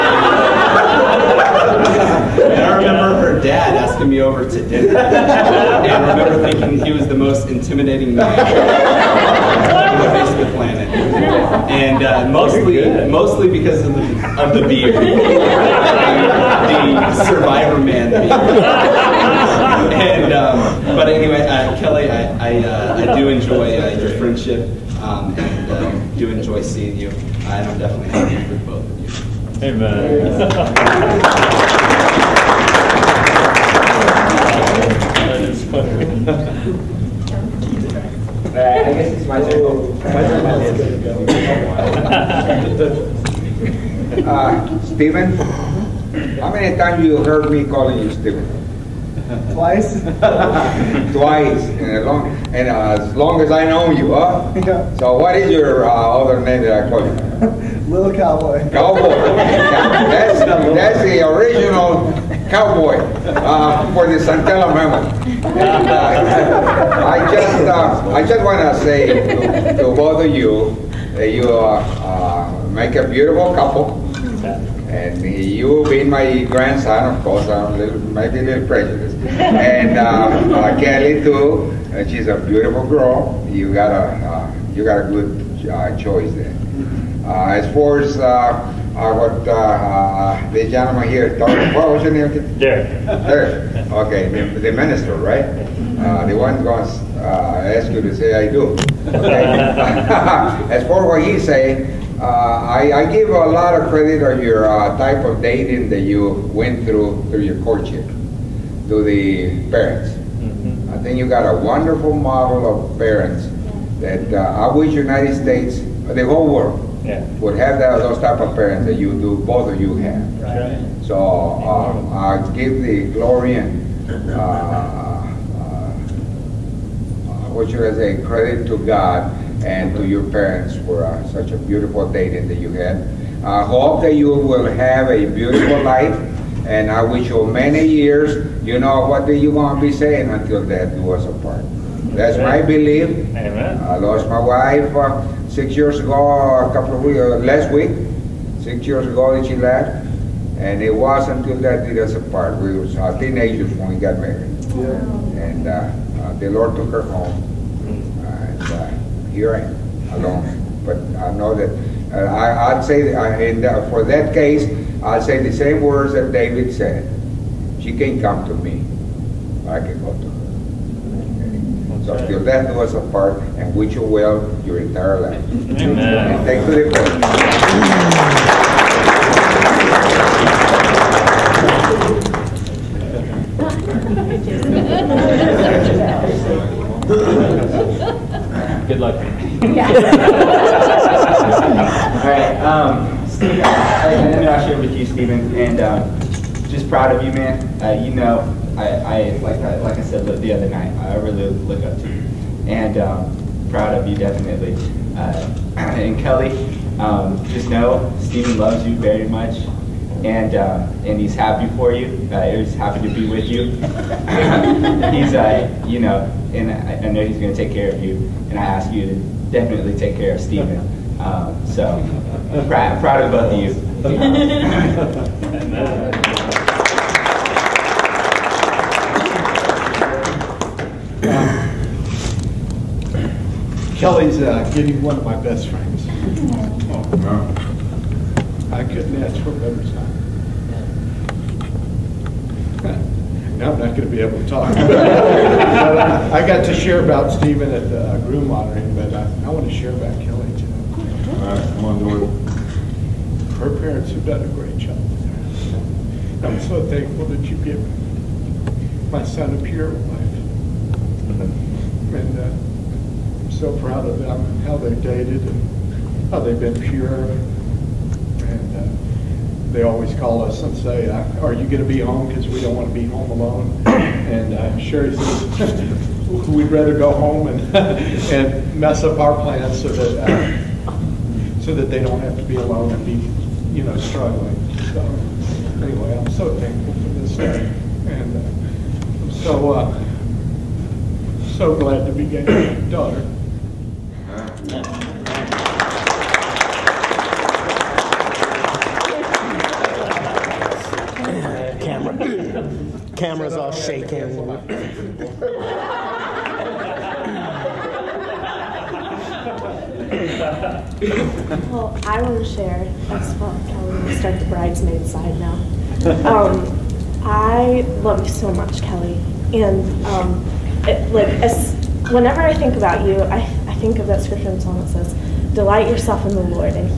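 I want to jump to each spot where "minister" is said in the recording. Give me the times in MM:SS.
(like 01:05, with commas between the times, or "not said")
01:34.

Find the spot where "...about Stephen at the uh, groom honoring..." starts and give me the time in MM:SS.
04:07.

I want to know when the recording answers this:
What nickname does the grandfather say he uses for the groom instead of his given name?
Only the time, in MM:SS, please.
00:57.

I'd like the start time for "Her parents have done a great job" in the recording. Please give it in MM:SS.
04:13.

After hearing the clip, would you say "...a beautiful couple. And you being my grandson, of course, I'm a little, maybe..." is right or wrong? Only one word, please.
right.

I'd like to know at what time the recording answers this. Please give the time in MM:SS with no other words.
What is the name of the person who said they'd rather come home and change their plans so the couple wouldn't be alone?
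04:34.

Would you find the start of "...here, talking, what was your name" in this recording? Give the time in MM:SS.
01:31.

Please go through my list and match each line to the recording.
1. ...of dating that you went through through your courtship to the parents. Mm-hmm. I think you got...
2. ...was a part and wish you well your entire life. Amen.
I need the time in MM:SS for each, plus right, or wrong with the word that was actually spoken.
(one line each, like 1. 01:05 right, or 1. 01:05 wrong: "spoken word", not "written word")
1. 01:45 right
2. 02:52 right.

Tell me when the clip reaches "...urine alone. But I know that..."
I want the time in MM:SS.
02:39.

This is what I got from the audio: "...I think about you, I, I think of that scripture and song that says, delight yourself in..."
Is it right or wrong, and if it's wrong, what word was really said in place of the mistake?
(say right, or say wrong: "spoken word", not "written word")
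right.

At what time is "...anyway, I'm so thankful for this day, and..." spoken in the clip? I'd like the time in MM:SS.
04:45.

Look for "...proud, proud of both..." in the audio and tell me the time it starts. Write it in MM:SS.
03:42.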